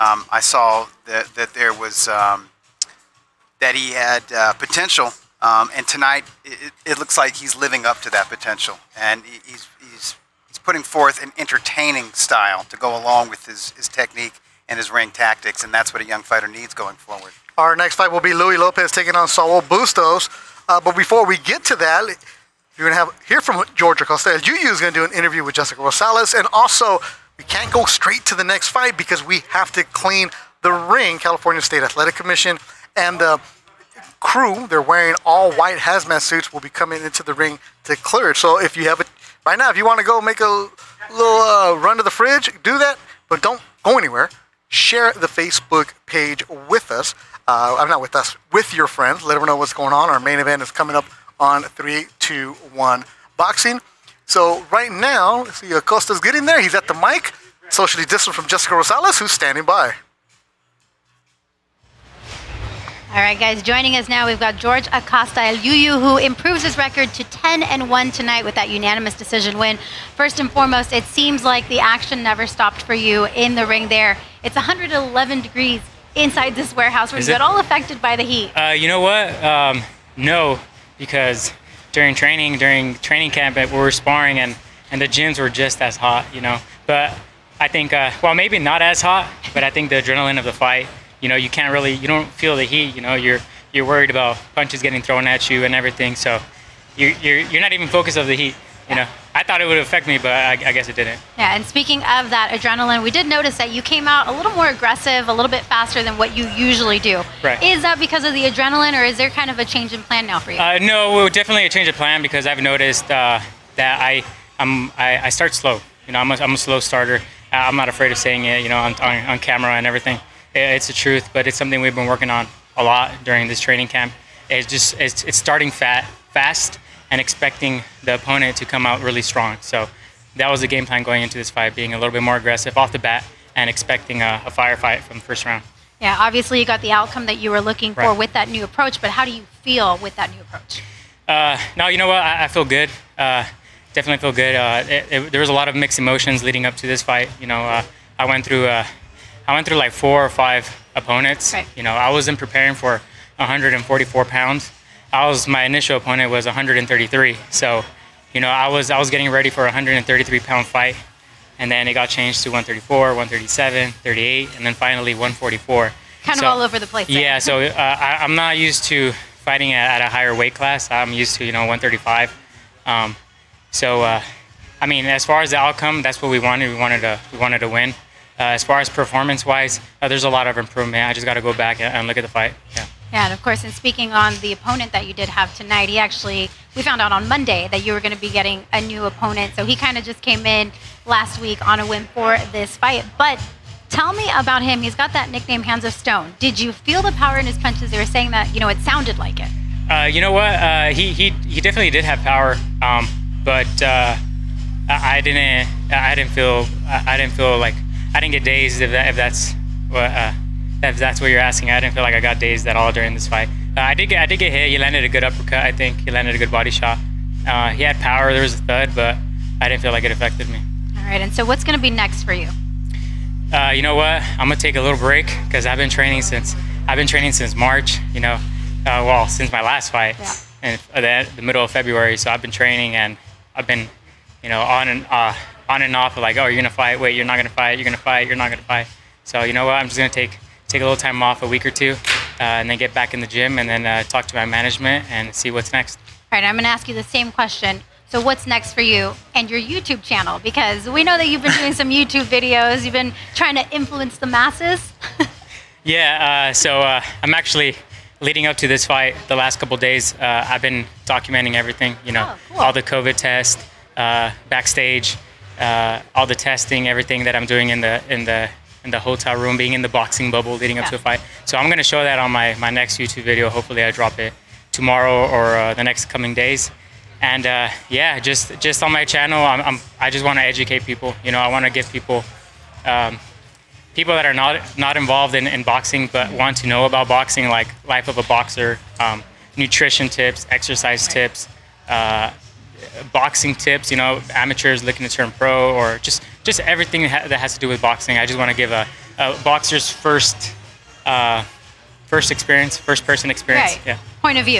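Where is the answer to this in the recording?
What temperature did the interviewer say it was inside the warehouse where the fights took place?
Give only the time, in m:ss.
1:14.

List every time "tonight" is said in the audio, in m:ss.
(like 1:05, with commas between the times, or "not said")
0:05, 1:08, 3:05.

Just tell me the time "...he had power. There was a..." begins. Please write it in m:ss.
3:37.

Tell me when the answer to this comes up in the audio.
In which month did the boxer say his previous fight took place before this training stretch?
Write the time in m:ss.
3:51.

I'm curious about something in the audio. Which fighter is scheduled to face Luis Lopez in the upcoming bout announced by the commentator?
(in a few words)
Saul Bustos.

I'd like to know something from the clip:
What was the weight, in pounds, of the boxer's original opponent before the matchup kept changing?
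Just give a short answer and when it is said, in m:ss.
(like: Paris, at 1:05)
133, at 2:35.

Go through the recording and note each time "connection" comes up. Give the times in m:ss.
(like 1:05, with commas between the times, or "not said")
not said.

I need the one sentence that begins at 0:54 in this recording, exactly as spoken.
So right now, see Acosta's getting there.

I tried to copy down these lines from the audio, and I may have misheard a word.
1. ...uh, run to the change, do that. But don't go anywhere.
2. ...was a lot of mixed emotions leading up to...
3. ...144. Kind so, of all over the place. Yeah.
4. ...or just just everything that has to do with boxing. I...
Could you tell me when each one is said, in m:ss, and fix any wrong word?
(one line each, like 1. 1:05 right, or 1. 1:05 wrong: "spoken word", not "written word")
1. 0:41 wrong: "fridge", not "change"
2. 2:25 right
3. 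2:45 right
4. 4:55 right.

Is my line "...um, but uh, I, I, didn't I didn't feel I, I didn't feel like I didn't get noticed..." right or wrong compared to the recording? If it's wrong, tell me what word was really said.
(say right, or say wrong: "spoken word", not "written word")
wrong: "dazed", not "noticed".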